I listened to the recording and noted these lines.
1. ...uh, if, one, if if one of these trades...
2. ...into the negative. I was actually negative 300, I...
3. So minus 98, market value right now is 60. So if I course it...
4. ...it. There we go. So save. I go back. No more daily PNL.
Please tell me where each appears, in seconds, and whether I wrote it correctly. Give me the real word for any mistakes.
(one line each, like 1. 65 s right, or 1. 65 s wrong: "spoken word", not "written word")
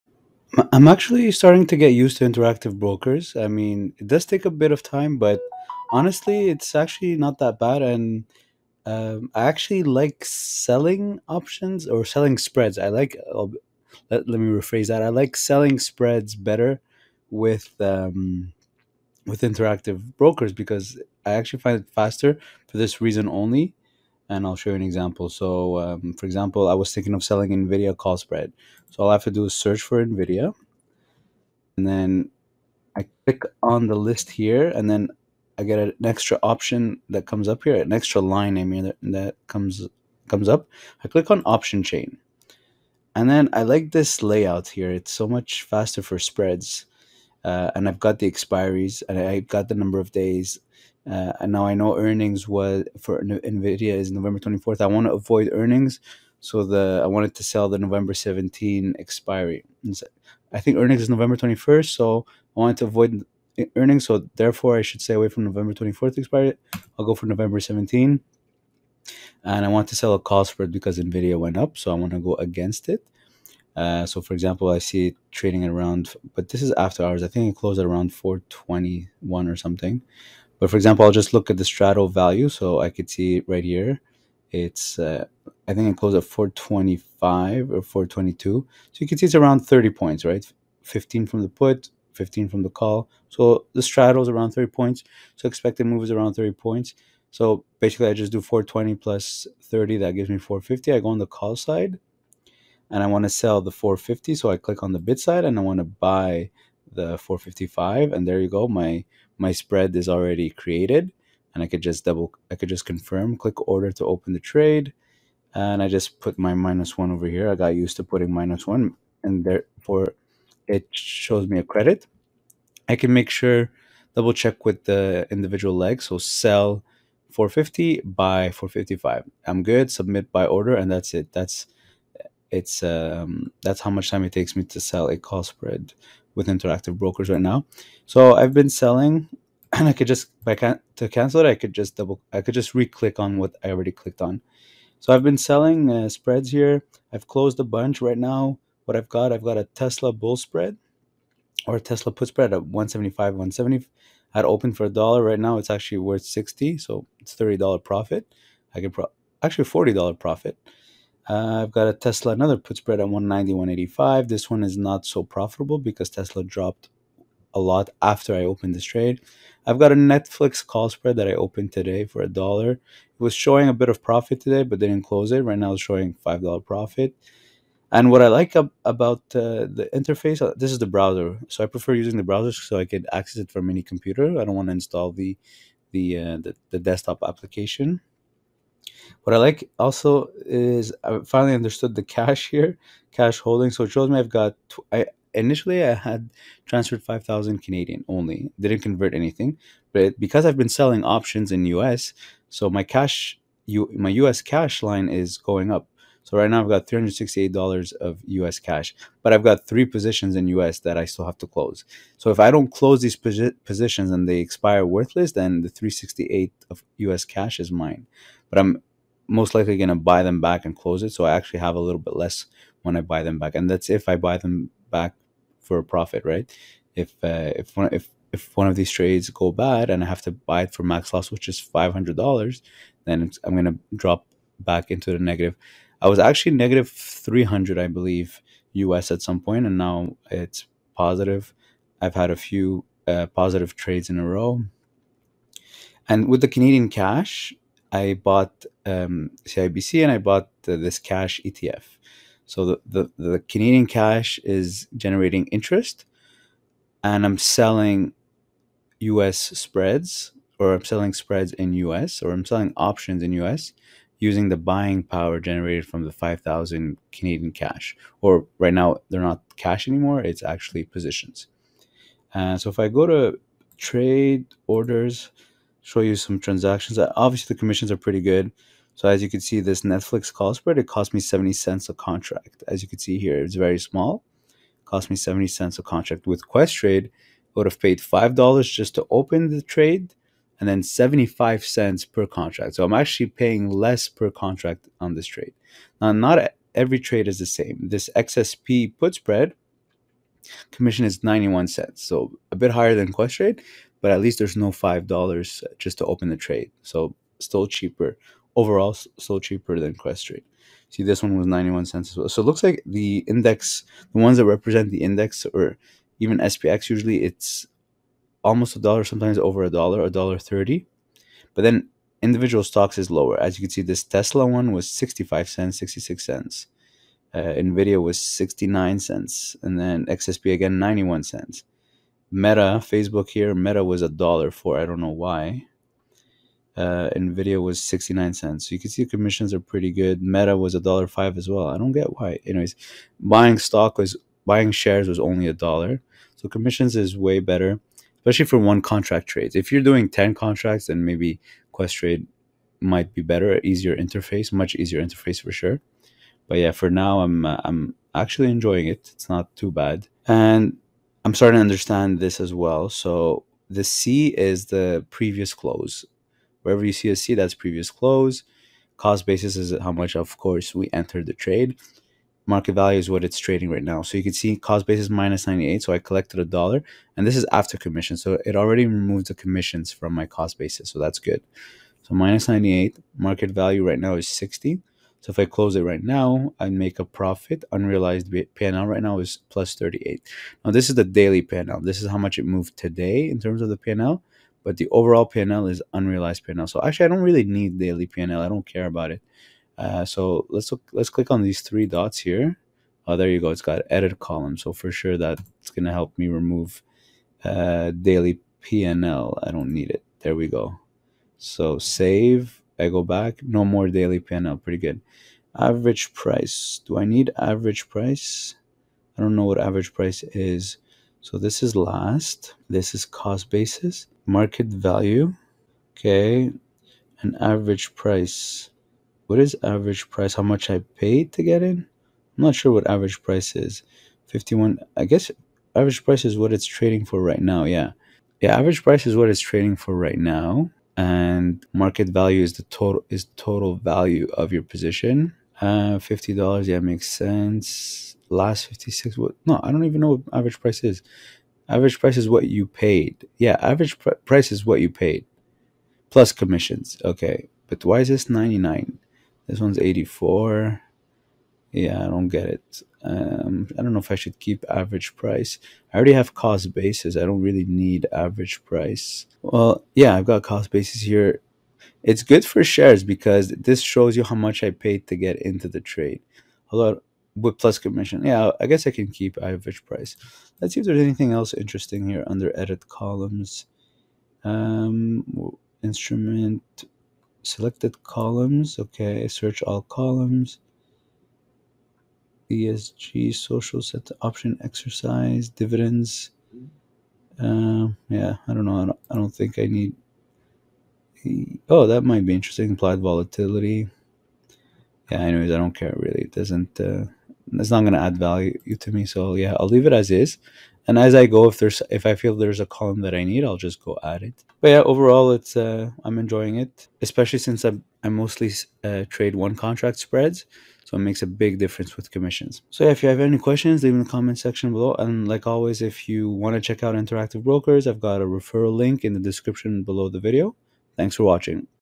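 1. 227 s right
2. 234 s right
3. 382 s wrong: "close", not "course"
4. 409 s right.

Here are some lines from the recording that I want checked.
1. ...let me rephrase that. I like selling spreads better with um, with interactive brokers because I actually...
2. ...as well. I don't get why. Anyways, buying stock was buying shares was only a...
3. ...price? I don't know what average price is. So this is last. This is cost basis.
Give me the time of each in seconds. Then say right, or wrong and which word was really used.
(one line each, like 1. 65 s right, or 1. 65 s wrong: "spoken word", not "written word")
1. 14 s right
2. 341 s right
3. 417 s right.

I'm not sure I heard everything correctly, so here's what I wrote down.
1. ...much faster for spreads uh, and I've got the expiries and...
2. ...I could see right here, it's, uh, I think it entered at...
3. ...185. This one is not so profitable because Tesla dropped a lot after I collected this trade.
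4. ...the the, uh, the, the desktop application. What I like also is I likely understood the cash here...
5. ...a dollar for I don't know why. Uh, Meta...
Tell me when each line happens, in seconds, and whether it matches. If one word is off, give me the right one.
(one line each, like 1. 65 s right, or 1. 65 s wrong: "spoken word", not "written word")
1. 45 s right
2. 82 s wrong: "closed", not "entered"
3. 163 s wrong: "opened", not "collected"
4. 185 s wrong: "finally", not "likely"
5. 334 s wrong: "Nvidia", not "Meta".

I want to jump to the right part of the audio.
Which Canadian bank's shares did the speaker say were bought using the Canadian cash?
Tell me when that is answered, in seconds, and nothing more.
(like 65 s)
249 s.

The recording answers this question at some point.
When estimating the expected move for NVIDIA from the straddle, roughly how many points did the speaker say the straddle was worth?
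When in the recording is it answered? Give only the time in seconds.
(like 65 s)
93 s.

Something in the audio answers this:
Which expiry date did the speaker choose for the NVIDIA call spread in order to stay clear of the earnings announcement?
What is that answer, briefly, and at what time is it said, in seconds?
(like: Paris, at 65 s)
November 17, at 66 s.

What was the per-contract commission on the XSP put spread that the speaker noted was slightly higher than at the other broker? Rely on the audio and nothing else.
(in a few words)
91 cents.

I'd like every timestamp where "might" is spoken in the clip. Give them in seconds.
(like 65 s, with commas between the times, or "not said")
352 s, 502 s.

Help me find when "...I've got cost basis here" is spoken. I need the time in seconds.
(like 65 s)
470 s.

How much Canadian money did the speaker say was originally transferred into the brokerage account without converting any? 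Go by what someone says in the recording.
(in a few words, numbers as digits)
5,000 Canadian.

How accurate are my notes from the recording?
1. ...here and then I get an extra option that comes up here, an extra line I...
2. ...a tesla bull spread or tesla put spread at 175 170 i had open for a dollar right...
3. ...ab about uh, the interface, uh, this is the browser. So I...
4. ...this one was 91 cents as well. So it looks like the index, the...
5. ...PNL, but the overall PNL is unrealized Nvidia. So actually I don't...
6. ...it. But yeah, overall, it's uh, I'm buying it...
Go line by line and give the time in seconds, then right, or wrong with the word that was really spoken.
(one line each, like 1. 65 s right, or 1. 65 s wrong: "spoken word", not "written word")
1. 34 s right
2. 149 s right
3. 178 s right
4. 311 s right
5. 393 s wrong: "PNL", not "Nvidia"
6. 514 s wrong: "enjoying", not "buying".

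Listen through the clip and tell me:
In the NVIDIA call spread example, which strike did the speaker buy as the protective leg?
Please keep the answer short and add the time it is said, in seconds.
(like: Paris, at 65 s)
455, at 105 s.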